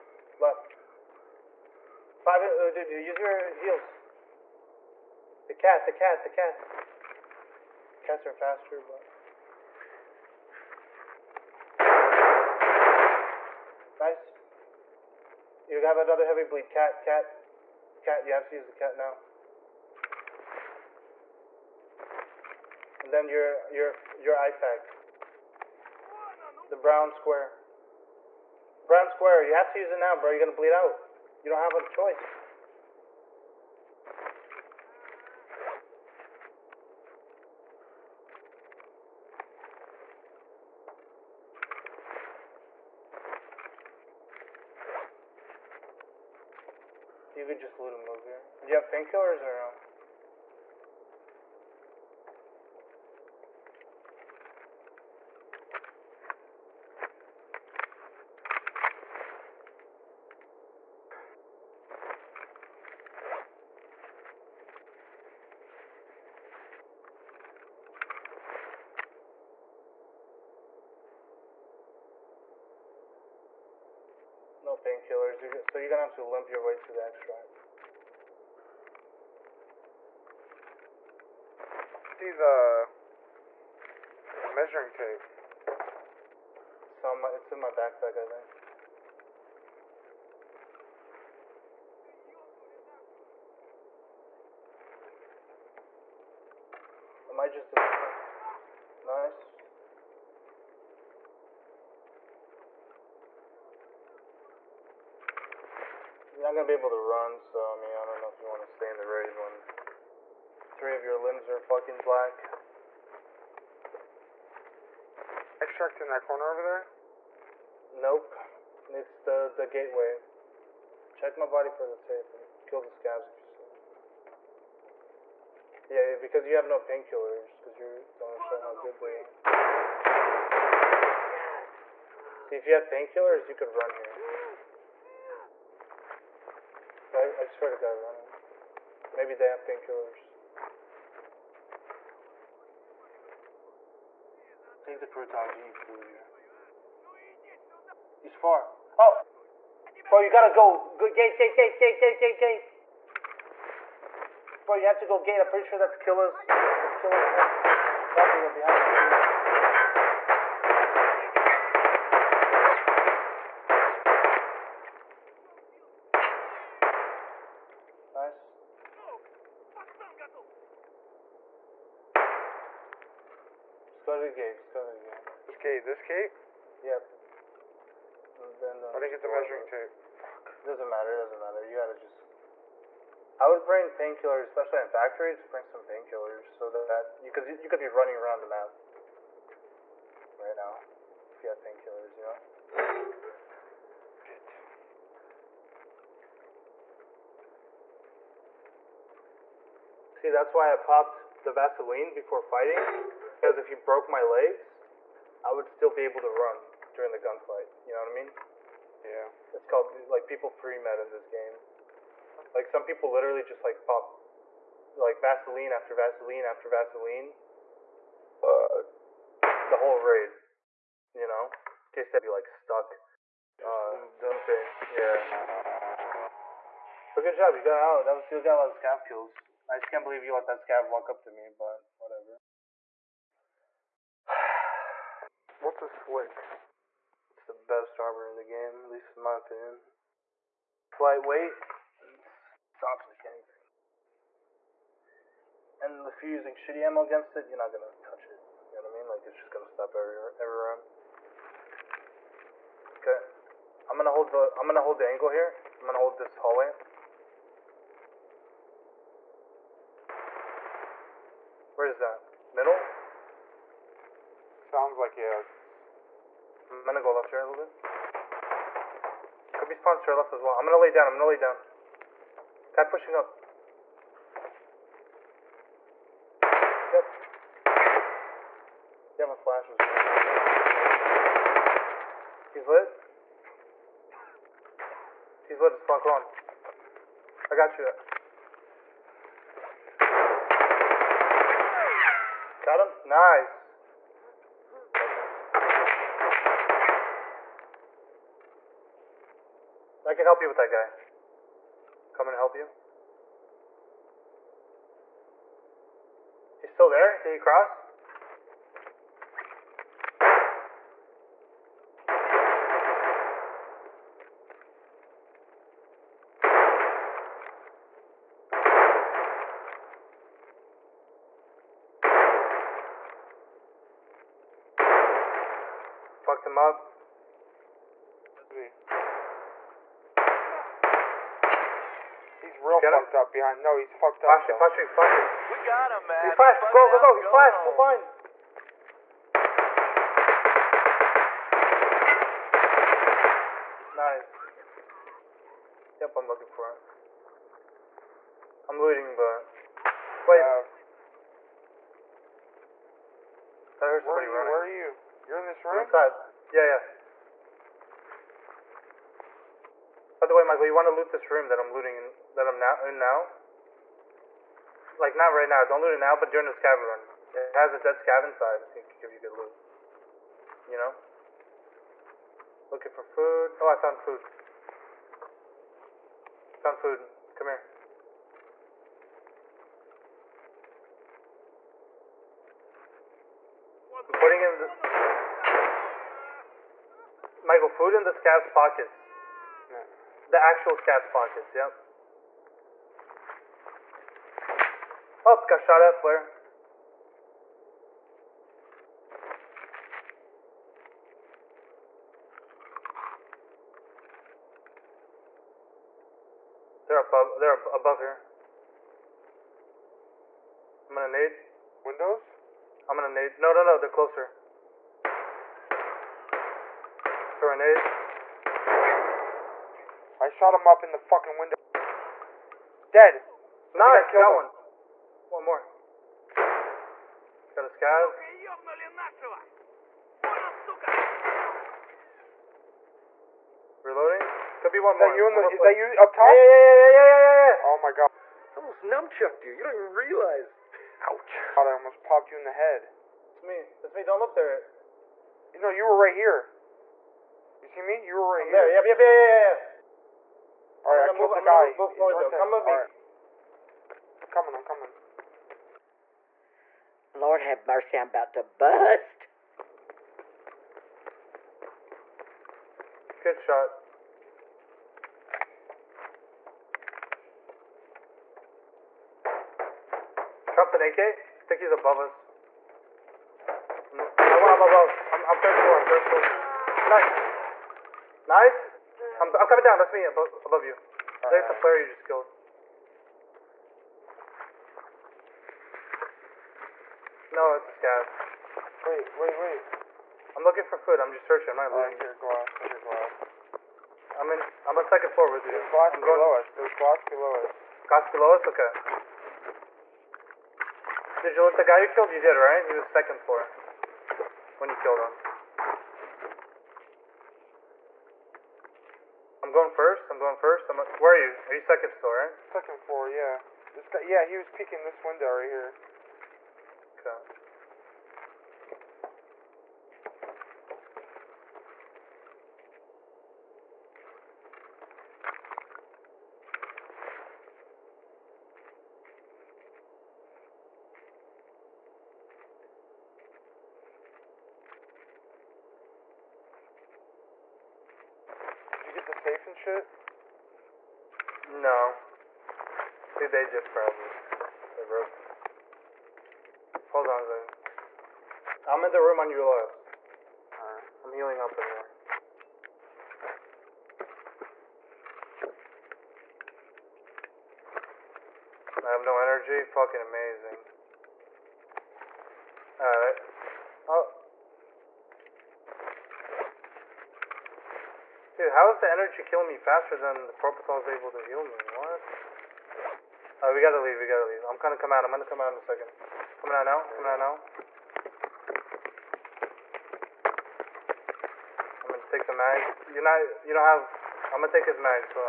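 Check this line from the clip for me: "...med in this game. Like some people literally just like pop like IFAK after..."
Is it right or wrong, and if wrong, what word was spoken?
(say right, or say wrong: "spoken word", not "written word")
wrong: "Vaseline", not "IFAK".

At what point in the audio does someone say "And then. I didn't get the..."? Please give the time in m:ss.
2:58.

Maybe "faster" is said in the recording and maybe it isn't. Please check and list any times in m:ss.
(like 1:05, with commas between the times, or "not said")
0:08, 9:29.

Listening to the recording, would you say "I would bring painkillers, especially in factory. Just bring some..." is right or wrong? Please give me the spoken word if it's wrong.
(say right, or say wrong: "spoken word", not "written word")
right.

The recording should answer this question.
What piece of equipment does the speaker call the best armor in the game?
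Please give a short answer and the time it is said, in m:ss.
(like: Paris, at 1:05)
Slick, at 3:55.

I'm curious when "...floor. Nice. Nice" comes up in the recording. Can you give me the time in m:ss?
7:57.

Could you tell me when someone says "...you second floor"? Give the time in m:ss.
8:31.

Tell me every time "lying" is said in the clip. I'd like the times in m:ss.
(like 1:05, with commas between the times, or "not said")
8:11.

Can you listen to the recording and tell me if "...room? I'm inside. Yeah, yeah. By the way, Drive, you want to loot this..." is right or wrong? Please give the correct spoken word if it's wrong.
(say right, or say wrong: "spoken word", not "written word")
wrong: "Michael", not "Drive".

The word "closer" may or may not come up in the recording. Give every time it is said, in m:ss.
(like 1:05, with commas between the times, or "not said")
6:53.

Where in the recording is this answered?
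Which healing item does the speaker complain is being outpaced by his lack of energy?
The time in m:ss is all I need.
9:30.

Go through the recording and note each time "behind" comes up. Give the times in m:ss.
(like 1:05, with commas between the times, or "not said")
2:38, 5:33.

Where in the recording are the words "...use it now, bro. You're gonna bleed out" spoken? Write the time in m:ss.
0:29.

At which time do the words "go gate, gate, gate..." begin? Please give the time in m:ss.
2:30.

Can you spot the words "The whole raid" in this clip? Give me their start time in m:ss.
3:39.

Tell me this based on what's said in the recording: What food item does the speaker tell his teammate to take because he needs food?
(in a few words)
Croutons.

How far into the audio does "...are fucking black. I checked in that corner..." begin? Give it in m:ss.
1:51.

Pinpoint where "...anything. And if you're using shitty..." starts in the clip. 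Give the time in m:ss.
4:03.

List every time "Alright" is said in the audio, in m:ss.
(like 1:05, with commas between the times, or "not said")
9:10, 9:22.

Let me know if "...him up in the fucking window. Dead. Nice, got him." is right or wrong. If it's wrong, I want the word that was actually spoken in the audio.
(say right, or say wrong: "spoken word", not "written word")
right.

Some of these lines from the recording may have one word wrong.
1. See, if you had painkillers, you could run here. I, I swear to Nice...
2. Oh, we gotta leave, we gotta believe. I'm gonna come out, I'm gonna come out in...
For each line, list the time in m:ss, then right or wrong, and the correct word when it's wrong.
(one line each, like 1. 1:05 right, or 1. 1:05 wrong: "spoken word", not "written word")
1. 2:12 wrong: "God", not "Nice"
2. 9:33 wrong: "leave", not "believe".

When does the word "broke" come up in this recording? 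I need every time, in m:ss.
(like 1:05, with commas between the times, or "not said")
3:23, 9:04.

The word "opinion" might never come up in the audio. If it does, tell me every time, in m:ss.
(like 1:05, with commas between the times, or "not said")
3:59.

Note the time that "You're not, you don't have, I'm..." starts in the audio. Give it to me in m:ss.
9:42.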